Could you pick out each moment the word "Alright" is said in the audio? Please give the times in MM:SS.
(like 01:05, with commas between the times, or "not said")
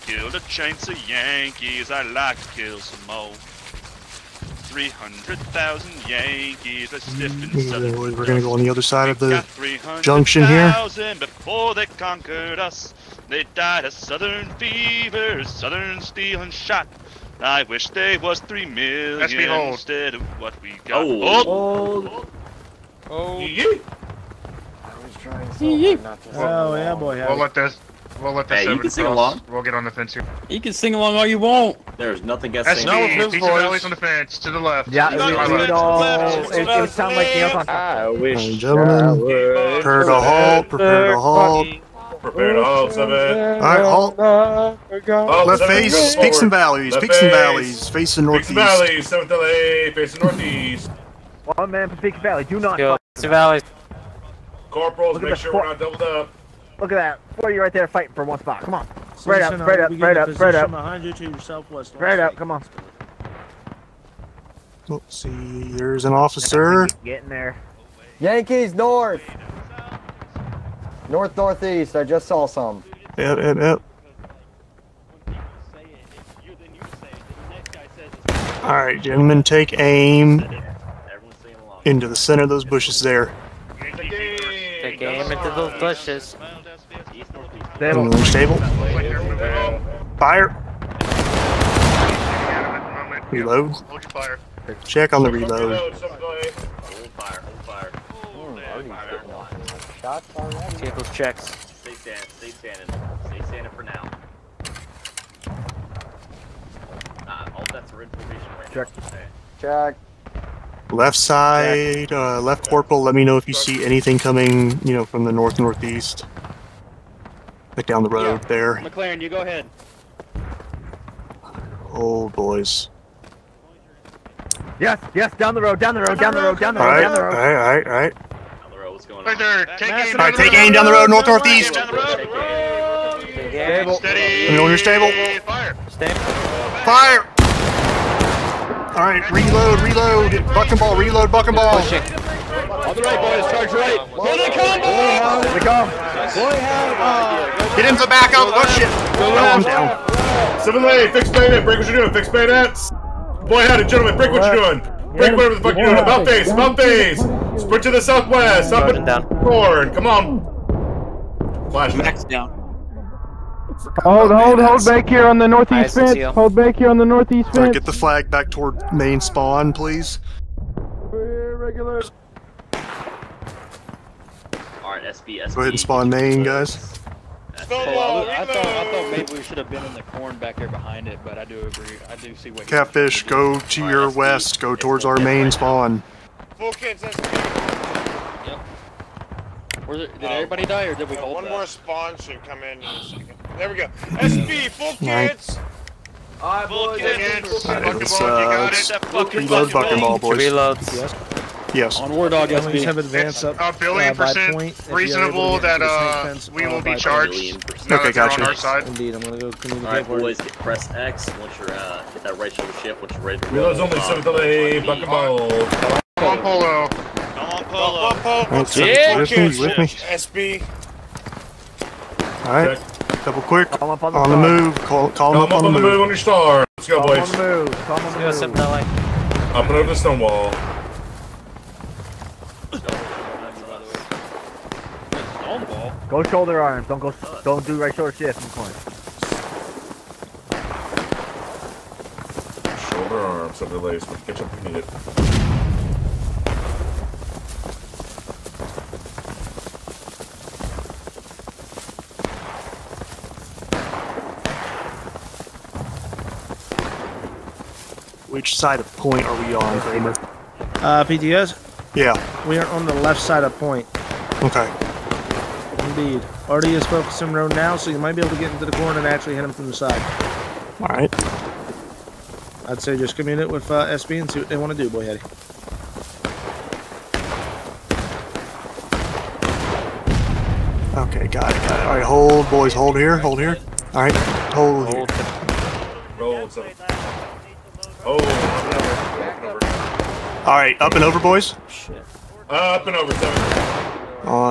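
02:54, 03:16, 03:30, 03:42, 04:50.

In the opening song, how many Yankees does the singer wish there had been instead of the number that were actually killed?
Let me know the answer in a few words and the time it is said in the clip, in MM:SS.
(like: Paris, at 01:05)
3 million, at 00:18.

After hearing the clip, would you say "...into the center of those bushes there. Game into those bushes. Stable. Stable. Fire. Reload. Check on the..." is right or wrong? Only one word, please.
right.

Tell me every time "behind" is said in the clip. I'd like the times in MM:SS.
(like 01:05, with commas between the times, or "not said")
01:00, 03:00.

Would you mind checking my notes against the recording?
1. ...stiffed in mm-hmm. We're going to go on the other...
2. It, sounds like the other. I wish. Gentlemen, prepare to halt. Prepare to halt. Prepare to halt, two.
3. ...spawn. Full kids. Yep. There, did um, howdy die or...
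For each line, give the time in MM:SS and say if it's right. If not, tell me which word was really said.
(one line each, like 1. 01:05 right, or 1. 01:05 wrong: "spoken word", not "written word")
1. 00:07 right
2. 00:36 wrong: "seven", not "two"
3. 03:05 wrong: "everybody", not "howdy".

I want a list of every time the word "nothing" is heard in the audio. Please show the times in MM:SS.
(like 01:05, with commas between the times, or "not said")
00:32.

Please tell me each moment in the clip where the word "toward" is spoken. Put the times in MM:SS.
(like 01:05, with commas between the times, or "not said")
02:48, 03:04.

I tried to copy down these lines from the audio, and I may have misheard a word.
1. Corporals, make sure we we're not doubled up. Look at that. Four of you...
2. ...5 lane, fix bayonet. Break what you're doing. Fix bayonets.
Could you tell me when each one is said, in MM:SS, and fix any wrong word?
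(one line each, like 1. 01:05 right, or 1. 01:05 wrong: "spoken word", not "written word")
1. 00:54 right
2. 02:30 wrong: "7", not "5".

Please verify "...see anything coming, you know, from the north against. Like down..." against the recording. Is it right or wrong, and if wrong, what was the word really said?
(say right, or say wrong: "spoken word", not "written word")
wrong: "northeast", not "against".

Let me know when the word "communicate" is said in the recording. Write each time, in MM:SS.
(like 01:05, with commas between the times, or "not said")
03:29.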